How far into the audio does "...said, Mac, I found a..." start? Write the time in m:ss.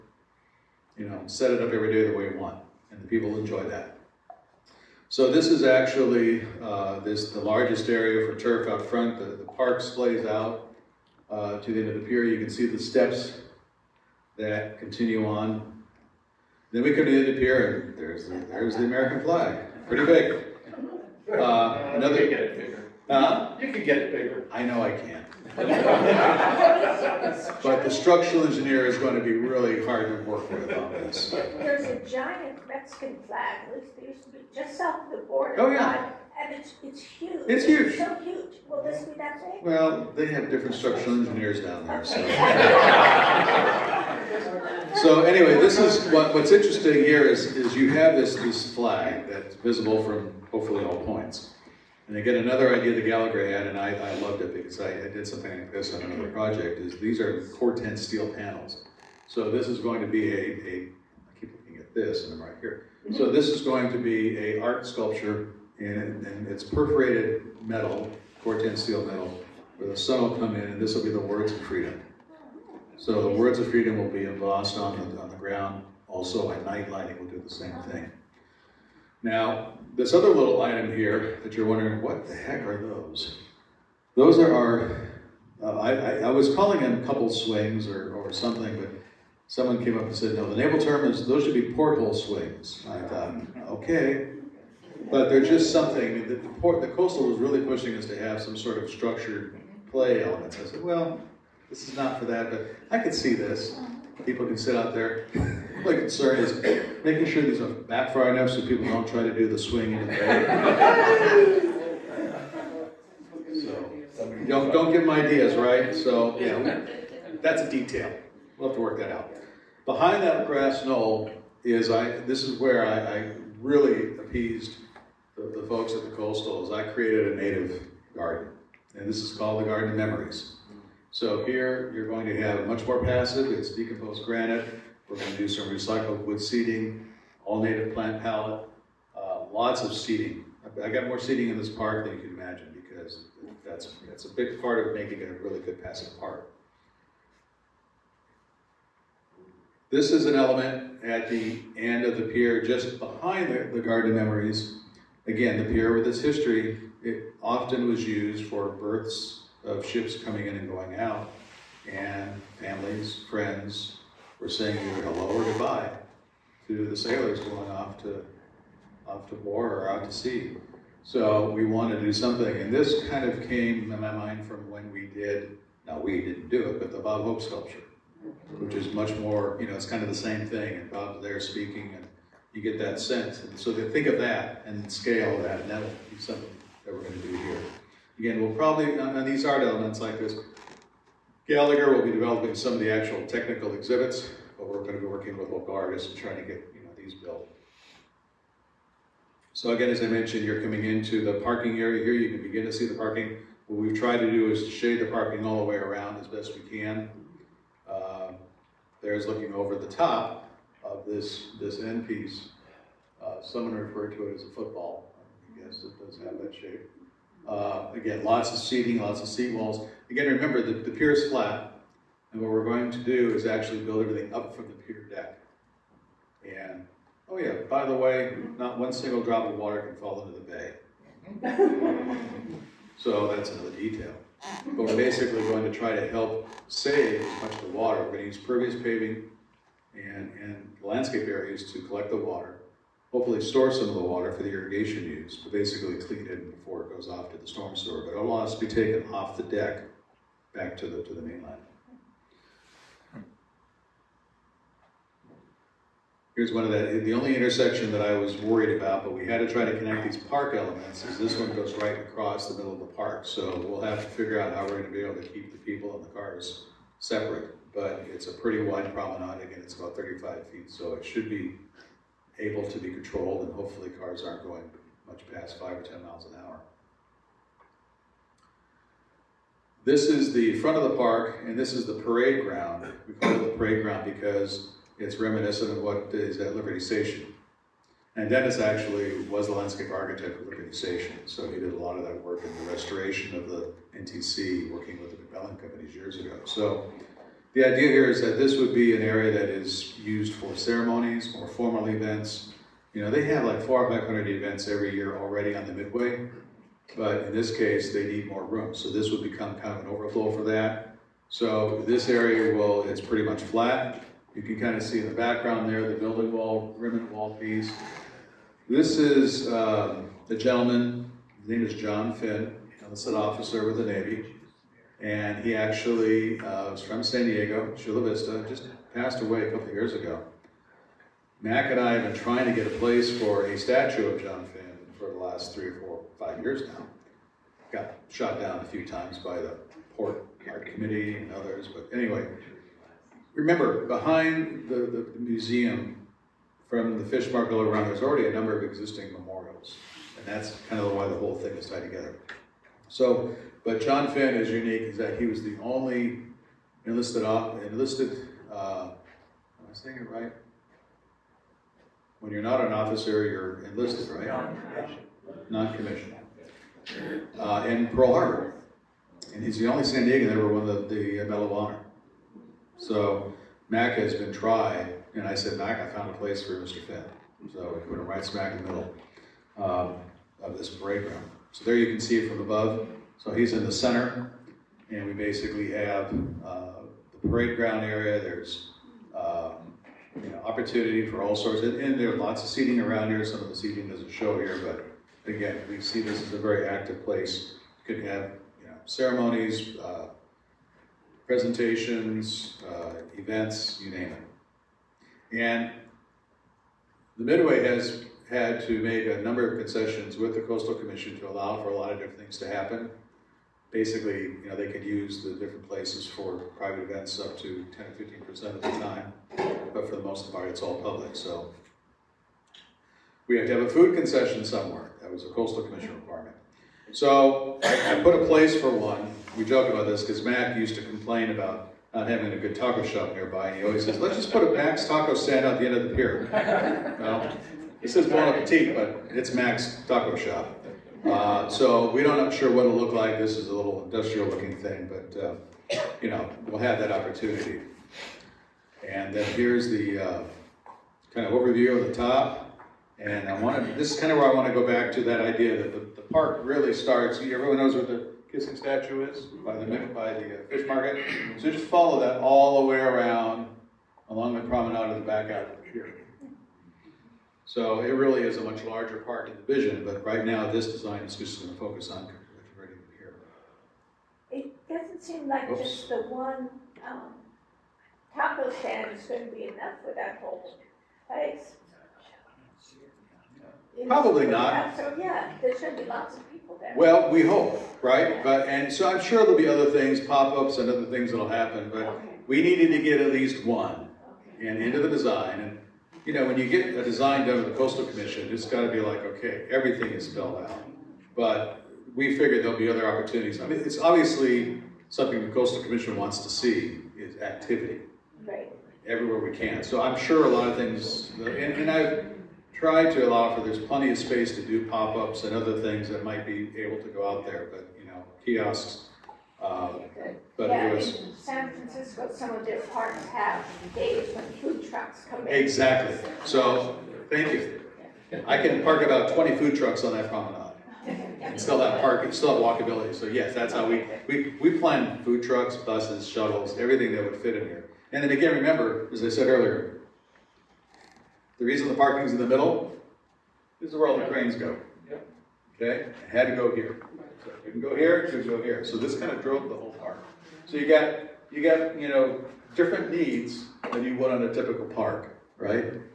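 6:15.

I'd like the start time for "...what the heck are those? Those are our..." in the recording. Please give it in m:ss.
1:22.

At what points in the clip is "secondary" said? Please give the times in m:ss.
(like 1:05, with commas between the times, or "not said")
not said.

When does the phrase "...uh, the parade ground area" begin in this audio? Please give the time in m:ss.
6:26.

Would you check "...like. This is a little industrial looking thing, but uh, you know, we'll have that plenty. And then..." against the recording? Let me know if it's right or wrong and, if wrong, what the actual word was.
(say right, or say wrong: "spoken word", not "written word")
wrong: "opportunity", not "plenty".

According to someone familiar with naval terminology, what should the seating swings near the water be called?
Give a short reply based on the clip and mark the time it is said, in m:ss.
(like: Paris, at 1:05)
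Porthole swings, at 1:31.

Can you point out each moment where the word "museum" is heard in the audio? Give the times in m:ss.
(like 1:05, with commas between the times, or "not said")
5:45.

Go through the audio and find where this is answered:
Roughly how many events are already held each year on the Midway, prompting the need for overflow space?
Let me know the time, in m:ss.
5:03.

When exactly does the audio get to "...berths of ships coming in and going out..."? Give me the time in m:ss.
2:38.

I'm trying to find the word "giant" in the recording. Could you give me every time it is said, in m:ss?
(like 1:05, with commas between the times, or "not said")
0:32.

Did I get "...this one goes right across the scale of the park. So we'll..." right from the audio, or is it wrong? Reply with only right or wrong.
wrong.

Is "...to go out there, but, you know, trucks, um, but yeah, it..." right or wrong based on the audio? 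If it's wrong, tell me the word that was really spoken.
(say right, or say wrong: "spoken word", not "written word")
wrong: "kiosks", not "trucks".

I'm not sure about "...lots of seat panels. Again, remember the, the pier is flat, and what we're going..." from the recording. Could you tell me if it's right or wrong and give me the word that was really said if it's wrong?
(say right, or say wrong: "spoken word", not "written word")
wrong: "walls", not "panels".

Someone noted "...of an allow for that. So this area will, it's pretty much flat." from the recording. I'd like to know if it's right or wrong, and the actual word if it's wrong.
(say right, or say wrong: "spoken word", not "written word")
wrong: "overflow", not "allow".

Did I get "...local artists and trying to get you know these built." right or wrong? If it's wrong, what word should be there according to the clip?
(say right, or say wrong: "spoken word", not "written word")
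right.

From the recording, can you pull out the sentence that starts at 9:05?
Okay, I had to go here.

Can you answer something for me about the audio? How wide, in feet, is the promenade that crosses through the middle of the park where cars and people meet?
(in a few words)
35 feet.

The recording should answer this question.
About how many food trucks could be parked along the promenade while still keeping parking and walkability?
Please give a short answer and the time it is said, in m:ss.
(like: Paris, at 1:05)
20, at 8:49.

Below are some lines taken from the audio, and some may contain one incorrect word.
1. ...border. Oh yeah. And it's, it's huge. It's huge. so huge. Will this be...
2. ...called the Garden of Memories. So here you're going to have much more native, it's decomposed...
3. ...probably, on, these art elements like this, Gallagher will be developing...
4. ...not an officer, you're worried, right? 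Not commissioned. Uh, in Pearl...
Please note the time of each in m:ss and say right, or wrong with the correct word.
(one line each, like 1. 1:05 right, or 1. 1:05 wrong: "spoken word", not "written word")
1. 0:35 right
2. 2:09 wrong: "passive", not "native"
3. 3:08 right
4. 6:02 wrong: "enlisted", not "worried".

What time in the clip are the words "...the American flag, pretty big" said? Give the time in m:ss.
0:18.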